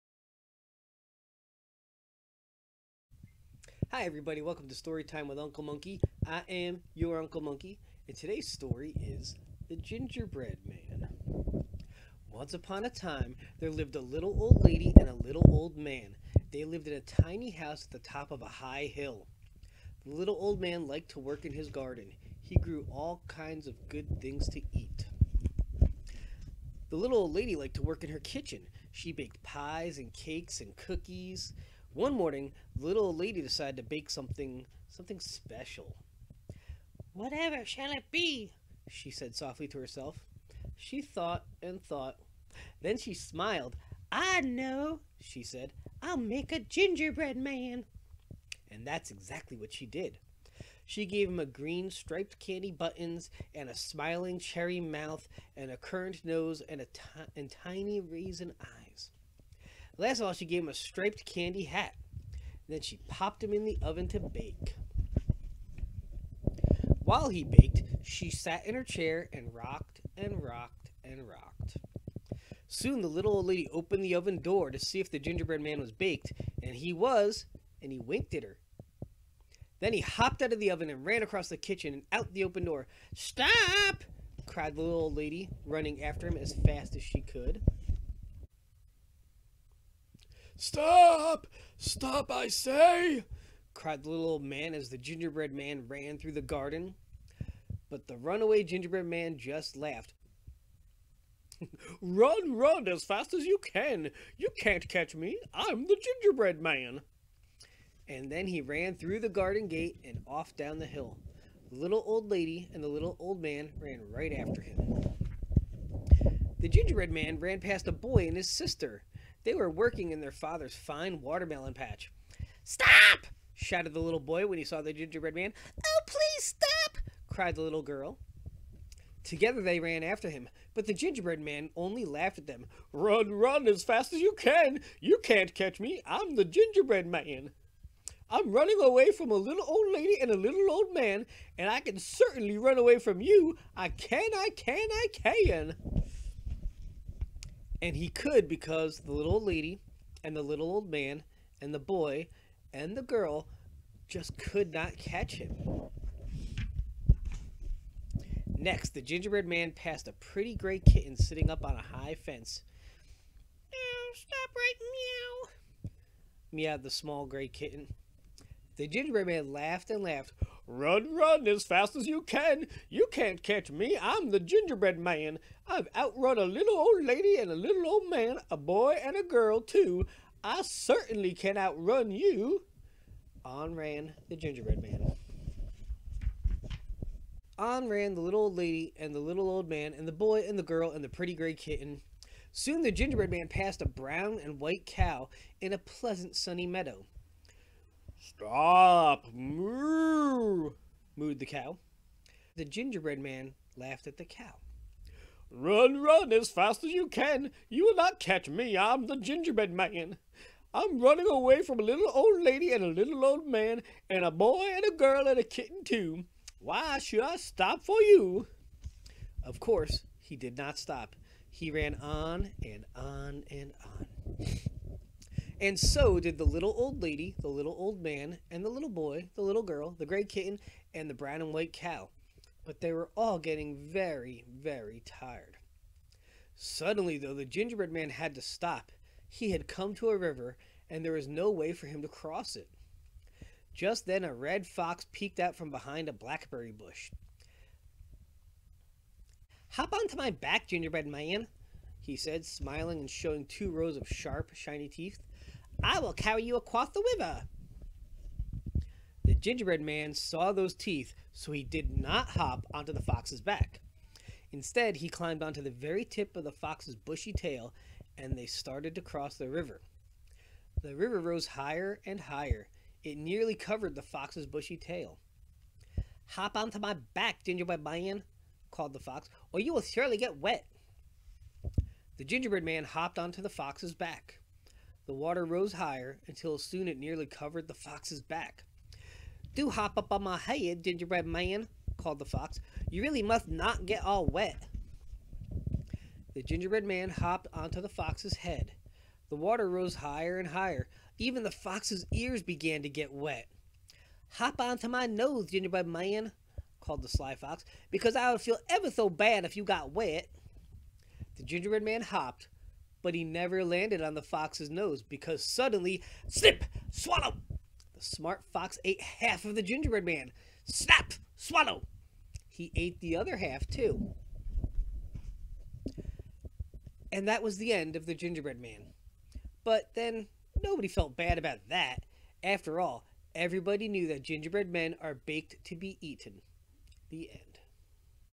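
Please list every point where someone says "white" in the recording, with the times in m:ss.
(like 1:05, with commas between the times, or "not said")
3:14, 3:51.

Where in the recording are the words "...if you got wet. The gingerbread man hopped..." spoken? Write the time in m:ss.
5:09.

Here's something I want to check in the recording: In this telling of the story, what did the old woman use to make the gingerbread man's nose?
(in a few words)
a currant.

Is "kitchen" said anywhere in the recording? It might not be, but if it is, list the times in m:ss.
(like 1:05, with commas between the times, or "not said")
0:28, 1:21.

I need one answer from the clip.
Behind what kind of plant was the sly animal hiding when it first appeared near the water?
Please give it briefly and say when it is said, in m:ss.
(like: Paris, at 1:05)
blackberry bush, at 4:06.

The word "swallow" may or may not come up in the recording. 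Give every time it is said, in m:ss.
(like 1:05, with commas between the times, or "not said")
5:16, 5:21.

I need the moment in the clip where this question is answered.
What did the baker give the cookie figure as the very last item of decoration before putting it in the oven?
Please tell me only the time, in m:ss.
1:00.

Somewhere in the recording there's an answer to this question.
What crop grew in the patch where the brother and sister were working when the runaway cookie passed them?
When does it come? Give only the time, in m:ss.
2:01.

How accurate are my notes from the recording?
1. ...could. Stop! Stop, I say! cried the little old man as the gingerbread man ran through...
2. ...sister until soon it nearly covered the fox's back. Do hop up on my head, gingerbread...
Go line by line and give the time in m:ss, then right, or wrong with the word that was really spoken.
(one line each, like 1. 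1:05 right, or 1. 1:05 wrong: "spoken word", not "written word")
1. 1:27 right
2. 4:45 wrong: "higher", not "sister".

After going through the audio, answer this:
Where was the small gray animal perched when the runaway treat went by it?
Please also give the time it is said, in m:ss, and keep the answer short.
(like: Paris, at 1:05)
a high fence, at 2:41.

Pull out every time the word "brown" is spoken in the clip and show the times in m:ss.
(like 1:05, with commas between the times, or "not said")
3:13, 3:51.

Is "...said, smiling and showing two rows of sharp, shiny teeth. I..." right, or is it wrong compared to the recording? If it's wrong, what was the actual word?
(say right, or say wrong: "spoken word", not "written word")
right.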